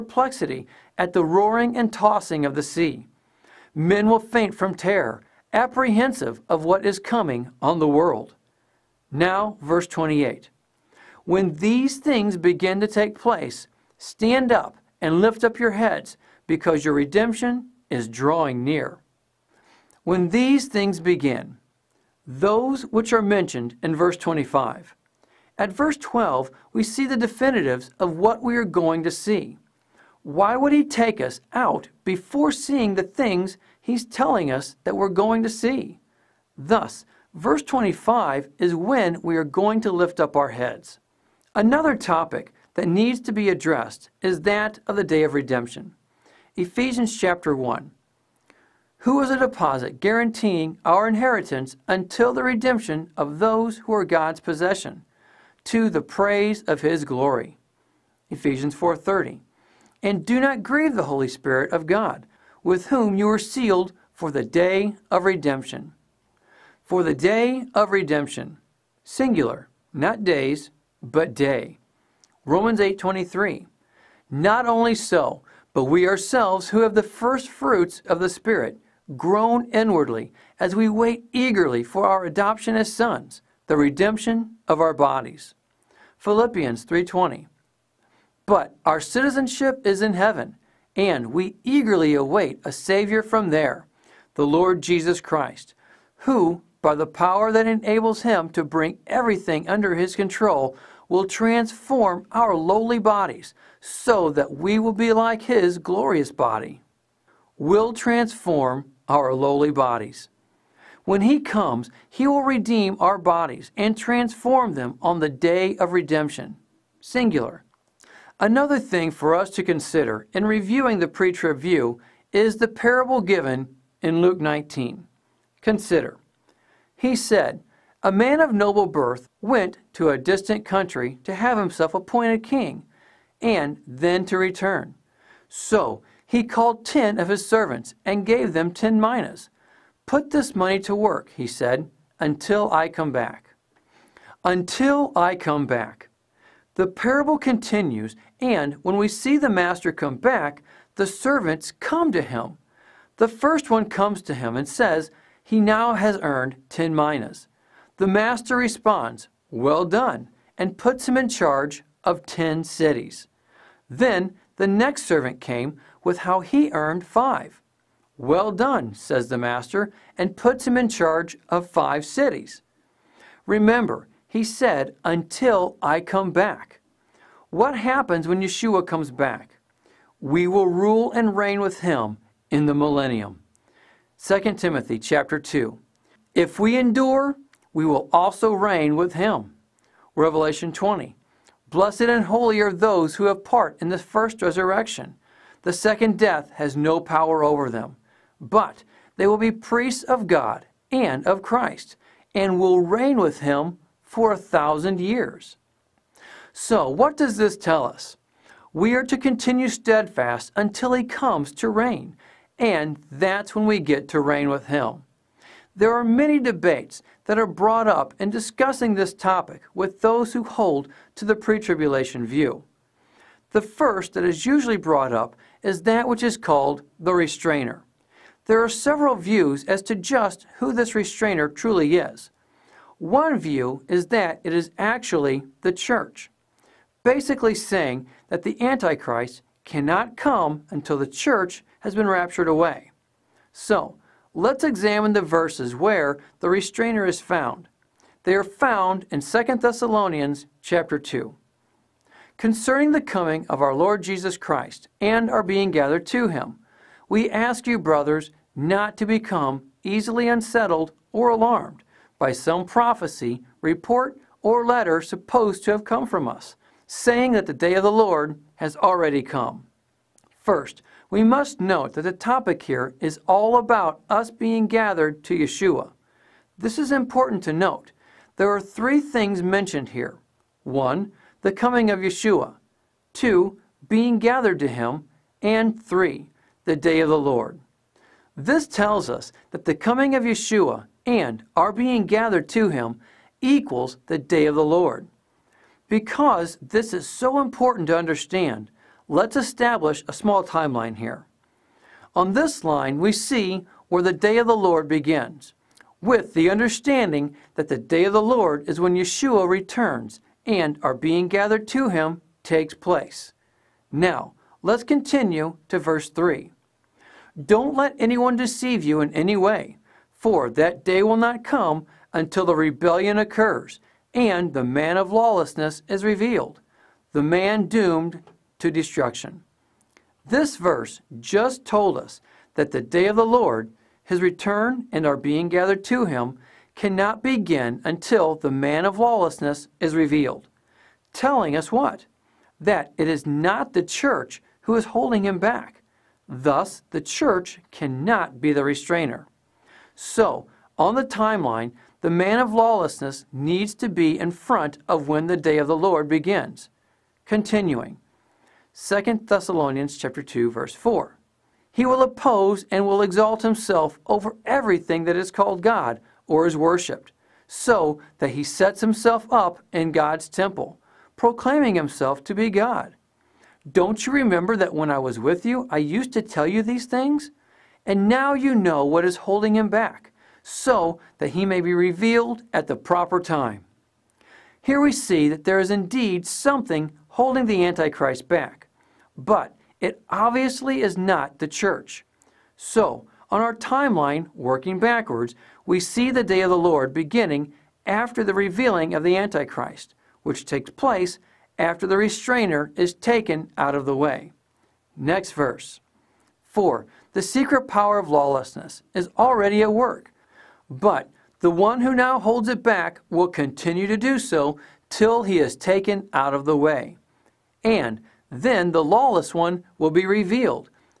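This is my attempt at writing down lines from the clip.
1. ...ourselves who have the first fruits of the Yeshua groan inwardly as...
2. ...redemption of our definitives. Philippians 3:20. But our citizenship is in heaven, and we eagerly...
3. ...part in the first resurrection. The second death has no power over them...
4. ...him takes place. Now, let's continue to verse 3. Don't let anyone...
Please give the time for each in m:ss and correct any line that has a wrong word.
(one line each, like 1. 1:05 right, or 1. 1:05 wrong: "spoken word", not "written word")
1. 1:16 wrong: "Spirit", not "Yeshua"
2. 1:23 wrong: "bodies", not "definitives"
3. 3:13 right
4. 5:11 right.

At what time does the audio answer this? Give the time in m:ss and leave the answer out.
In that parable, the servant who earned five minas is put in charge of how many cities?
2:51.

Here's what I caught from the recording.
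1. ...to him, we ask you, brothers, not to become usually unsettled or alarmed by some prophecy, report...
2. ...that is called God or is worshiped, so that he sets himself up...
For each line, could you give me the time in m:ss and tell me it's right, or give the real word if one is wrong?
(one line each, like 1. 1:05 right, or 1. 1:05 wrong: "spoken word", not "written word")
1. 4:16 wrong: "easily", not "usually"
2. 6:05 right.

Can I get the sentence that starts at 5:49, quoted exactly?
So, on the timeline, the man of lawlessness needs to be in front of when the day of the Lord begins.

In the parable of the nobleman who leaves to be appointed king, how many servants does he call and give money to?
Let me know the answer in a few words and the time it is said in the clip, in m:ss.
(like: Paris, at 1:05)
10, at 2:16.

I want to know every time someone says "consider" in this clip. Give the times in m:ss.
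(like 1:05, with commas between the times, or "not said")
1:59, 2:05.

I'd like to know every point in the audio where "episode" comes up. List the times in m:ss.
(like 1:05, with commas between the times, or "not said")
not said.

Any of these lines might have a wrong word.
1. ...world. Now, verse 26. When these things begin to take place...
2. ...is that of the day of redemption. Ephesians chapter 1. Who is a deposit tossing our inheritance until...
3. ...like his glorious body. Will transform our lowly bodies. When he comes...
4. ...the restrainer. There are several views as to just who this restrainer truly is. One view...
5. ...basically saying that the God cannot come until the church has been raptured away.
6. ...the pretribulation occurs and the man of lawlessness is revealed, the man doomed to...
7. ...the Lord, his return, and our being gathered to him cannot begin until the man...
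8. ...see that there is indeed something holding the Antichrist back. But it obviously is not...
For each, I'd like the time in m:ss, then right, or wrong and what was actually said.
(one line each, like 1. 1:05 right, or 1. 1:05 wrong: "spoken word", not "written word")
1. 0:07 wrong: "28", not "26"
2. 0:44 wrong: "guaranteeing", not "tossing"
3. 1:45 right
4. 3:46 right
5. 3:57 wrong: "Antichrist", not "God"
6. 5:22 wrong: "rebellion", not "pretribulation"
7. 5:33 right
8. 6:24 right.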